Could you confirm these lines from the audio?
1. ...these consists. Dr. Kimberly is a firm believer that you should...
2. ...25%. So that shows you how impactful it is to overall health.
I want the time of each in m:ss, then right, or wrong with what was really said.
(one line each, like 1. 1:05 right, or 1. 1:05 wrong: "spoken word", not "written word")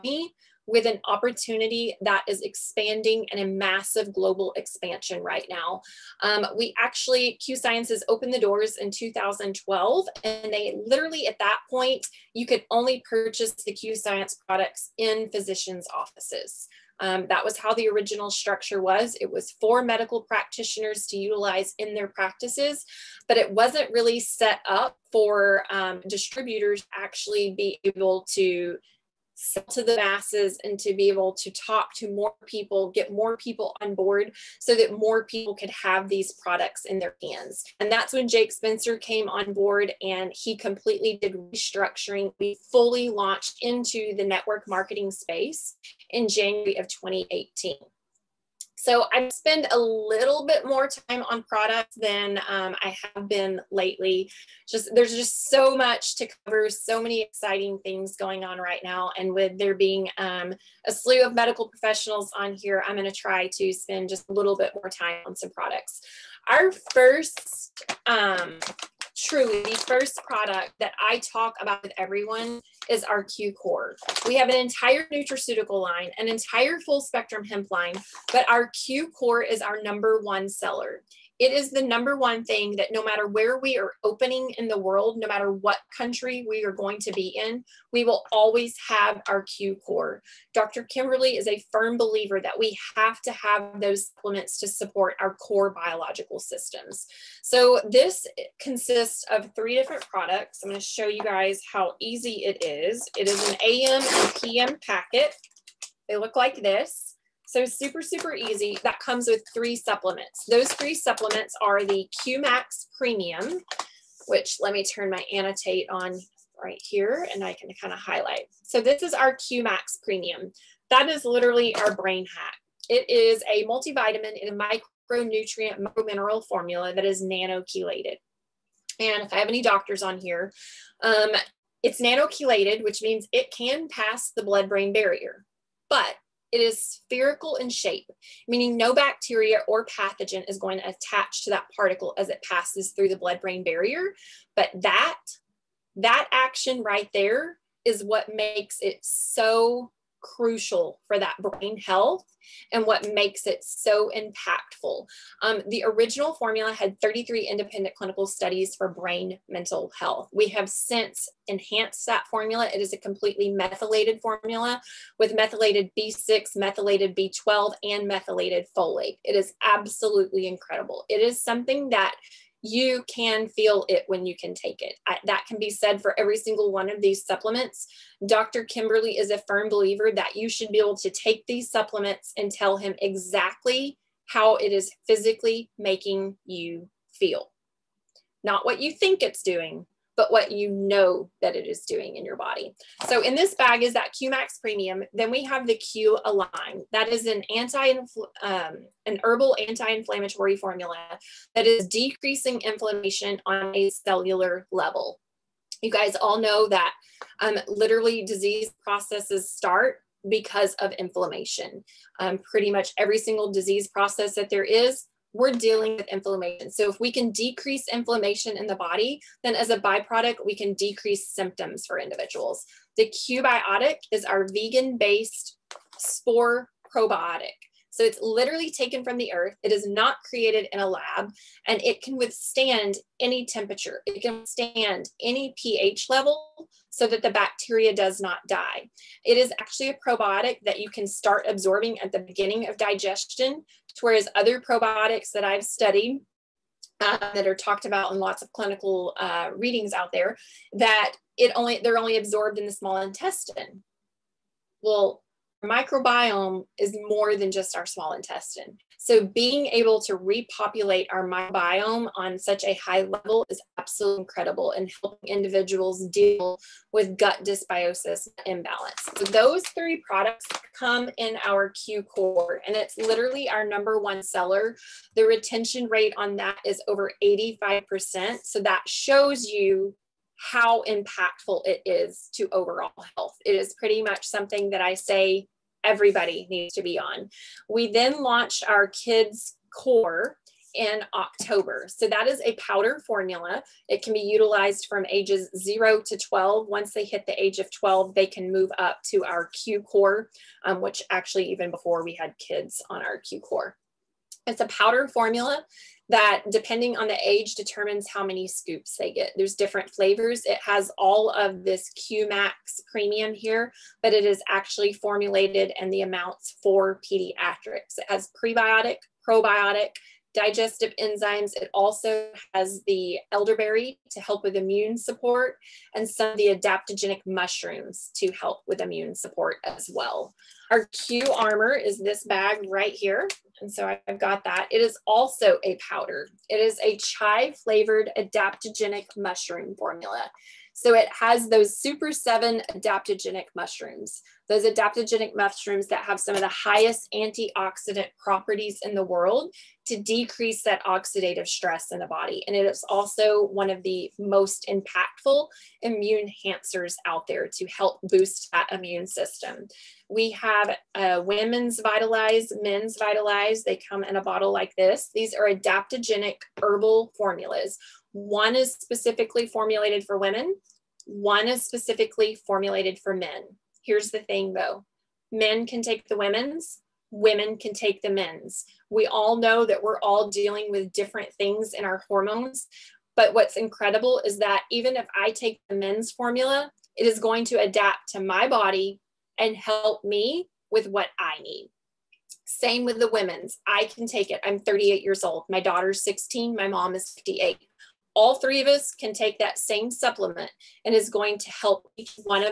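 1. 2:57 wrong: "supplements", not "consists"
2. 4:37 wrong: "85", not "25".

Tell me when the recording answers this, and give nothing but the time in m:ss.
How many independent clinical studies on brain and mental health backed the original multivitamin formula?
2:36.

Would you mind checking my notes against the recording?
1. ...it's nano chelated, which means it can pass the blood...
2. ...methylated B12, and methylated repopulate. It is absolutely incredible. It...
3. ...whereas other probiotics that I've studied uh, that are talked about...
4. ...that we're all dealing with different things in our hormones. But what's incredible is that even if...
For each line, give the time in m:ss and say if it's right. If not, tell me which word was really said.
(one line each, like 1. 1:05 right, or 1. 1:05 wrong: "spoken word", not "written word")
1. 2:11 right
2. 2:46 wrong: "folate", not "repopulate"
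3. 4:03 right
4. 6:19 right.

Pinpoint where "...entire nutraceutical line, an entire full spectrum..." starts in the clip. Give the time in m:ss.
1:14.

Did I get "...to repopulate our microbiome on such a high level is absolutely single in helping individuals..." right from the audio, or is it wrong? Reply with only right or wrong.
wrong.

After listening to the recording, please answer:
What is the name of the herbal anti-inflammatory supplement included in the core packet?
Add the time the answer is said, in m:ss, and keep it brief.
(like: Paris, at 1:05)
Q Align, at 3:15.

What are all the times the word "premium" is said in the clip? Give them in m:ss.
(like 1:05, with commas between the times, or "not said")
1:52, 2:00, 3:14, 5:12.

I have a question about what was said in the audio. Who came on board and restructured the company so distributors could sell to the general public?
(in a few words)
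Jake Spencer.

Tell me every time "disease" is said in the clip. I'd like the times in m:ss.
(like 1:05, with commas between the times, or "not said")
3:28, 3:33.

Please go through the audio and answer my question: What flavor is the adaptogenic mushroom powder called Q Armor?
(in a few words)
chai.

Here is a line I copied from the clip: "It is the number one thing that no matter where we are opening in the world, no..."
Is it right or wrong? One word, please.
right.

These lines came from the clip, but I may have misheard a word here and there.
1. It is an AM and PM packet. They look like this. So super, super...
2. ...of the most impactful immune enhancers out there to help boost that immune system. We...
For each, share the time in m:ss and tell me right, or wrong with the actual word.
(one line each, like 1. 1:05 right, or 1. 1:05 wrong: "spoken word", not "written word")
1. 1:43 right
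2. 5:53 right.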